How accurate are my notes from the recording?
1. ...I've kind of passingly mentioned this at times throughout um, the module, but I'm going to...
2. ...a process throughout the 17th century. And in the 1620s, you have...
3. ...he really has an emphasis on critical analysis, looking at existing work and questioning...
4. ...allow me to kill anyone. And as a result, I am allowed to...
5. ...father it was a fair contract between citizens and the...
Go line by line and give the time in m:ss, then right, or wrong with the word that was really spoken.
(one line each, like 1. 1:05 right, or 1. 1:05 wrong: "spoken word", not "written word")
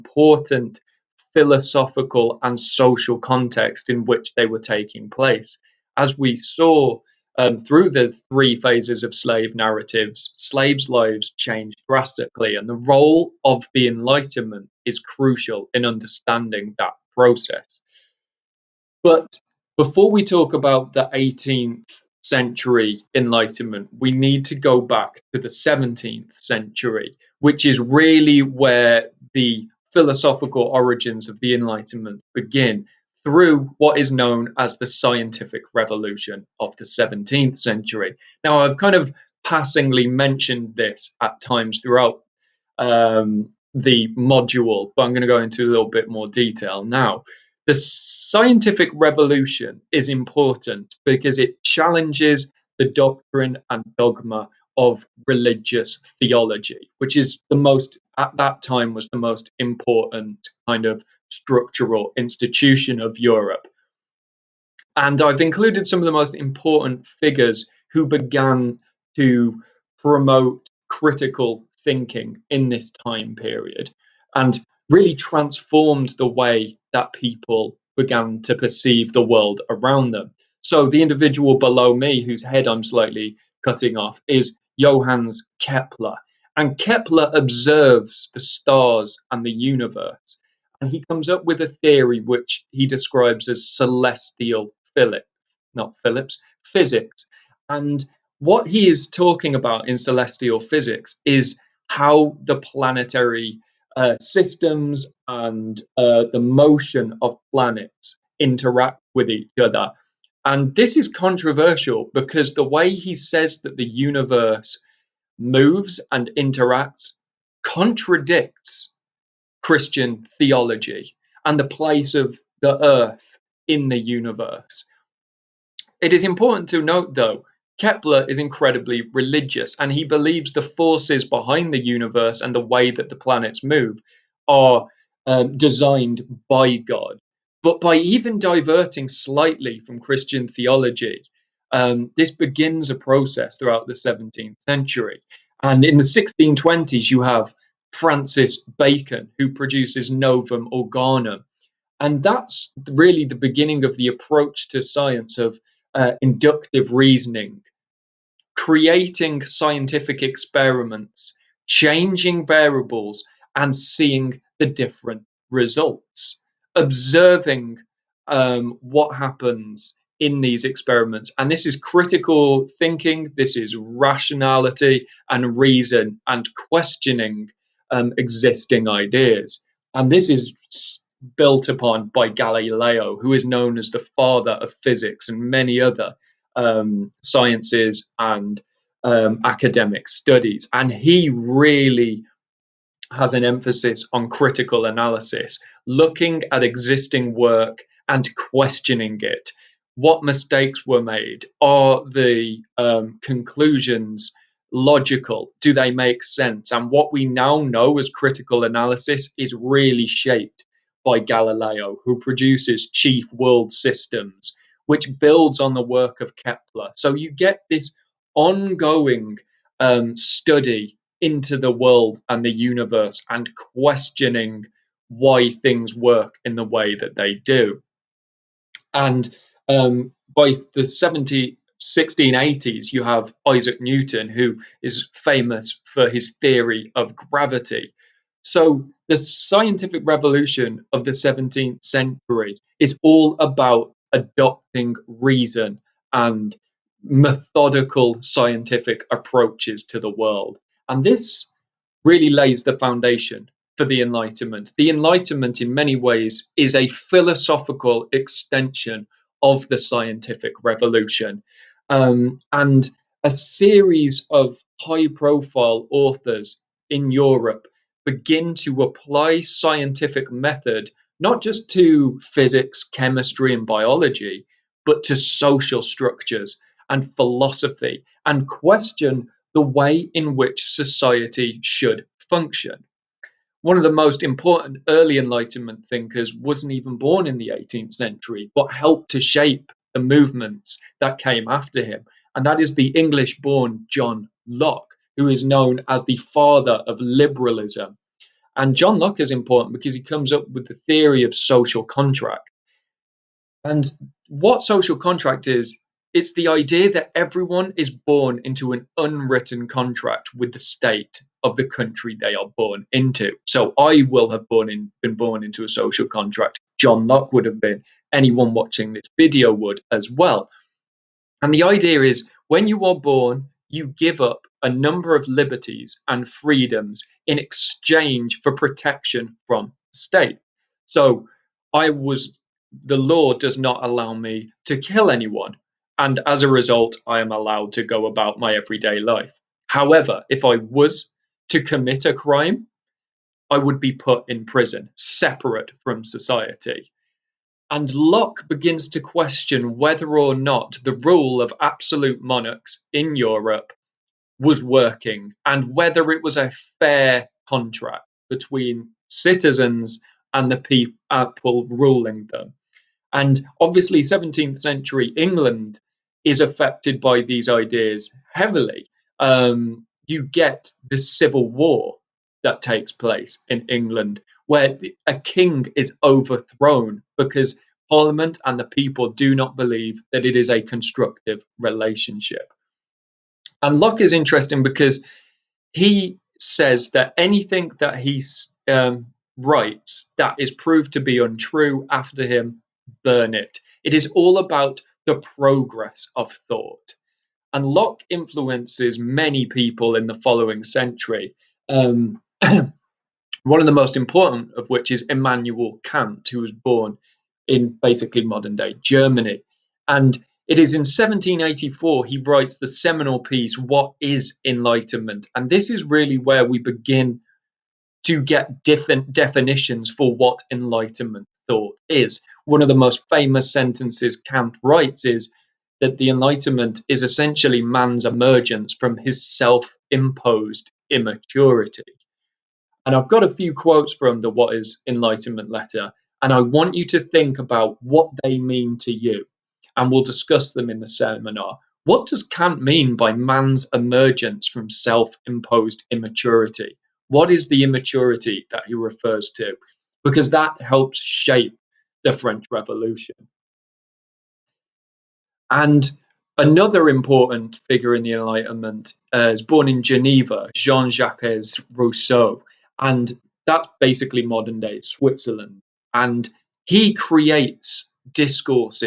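1. 0:38 right
2. 2:22 right
3. 3:10 right
4. 5:33 right
5. 5:55 wrong: "whether", not "father".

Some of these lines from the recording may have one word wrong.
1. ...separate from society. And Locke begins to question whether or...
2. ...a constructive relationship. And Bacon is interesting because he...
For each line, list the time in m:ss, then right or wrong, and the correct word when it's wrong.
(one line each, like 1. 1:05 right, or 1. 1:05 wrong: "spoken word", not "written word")
1. 5:44 right
2. 6:20 wrong: "Locke", not "Bacon".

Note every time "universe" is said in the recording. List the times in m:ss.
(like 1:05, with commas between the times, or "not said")
1:29, 1:53, 2:03, 2:11, 3:42.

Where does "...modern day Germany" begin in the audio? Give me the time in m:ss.
6:48.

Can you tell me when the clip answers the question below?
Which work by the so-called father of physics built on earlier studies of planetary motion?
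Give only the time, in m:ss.
3:32.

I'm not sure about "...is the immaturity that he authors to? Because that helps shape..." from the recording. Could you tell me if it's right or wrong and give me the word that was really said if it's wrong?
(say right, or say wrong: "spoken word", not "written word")
wrong: "refers", not "authors".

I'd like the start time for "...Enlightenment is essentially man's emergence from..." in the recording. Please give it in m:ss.
7:06.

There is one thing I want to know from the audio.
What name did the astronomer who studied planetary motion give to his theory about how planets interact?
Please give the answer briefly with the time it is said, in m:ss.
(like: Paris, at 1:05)
celestial physics, at 1:33.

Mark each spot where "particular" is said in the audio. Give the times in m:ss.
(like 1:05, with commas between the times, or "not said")
not said.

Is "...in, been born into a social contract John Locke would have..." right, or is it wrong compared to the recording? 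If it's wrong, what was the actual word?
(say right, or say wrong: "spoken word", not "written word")
right.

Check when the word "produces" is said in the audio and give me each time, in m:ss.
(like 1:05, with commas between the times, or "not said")
2:29, 3:32.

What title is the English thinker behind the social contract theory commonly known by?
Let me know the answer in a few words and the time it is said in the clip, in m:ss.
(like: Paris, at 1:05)
father of liberalism, at 4:56.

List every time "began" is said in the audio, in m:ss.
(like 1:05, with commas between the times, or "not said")
1:08, 1:17.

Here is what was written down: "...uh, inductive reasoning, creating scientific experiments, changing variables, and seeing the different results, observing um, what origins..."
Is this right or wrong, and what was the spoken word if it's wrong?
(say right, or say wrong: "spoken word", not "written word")
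wrong: "happens", not "origins".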